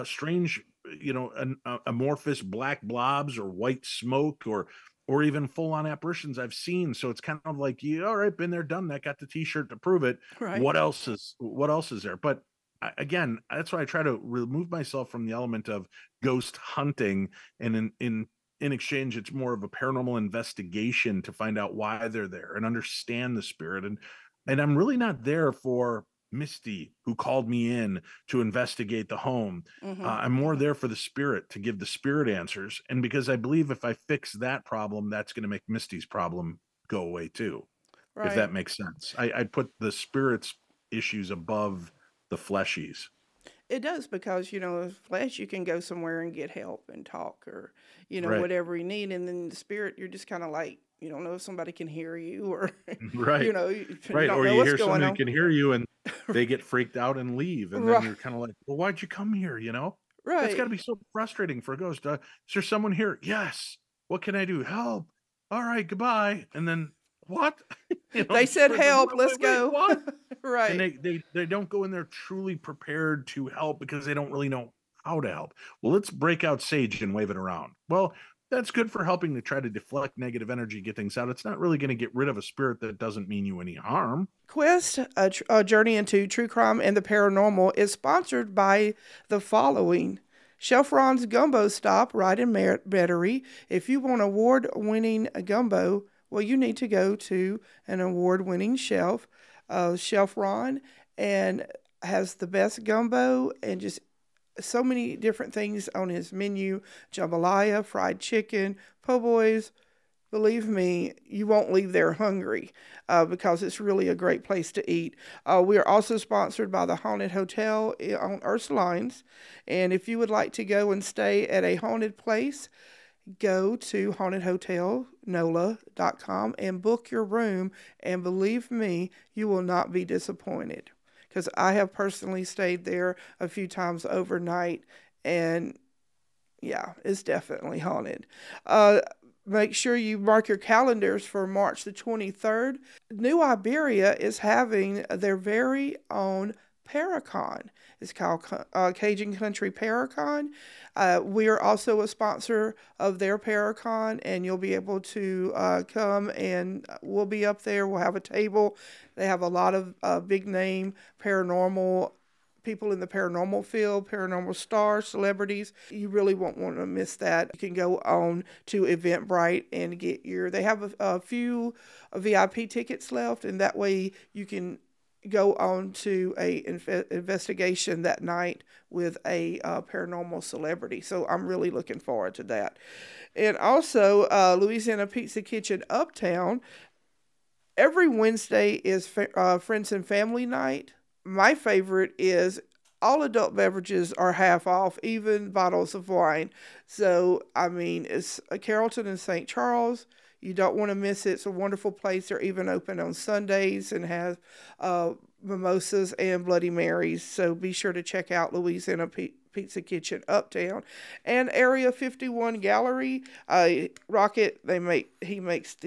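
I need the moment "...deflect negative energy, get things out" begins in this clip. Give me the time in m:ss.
1:19.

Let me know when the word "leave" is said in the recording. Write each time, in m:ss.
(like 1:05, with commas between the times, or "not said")
0:57, 1:51.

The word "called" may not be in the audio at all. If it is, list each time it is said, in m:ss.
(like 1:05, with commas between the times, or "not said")
0:27, 2:28.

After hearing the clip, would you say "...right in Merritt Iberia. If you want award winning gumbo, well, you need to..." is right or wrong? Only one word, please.
wrong.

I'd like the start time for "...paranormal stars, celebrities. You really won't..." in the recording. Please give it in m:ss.
2:44.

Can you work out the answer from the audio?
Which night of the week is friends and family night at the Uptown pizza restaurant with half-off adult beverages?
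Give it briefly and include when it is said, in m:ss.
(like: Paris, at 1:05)
Wednesday, at 3:08.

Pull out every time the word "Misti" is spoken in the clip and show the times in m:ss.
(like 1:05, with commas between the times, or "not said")
0:26, 0:35.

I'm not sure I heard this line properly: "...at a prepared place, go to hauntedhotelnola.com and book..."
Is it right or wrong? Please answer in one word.
wrong.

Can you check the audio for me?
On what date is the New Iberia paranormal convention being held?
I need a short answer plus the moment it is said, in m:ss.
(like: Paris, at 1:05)
March 23, at 2:21.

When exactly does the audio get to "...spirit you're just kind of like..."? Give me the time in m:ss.
0:49.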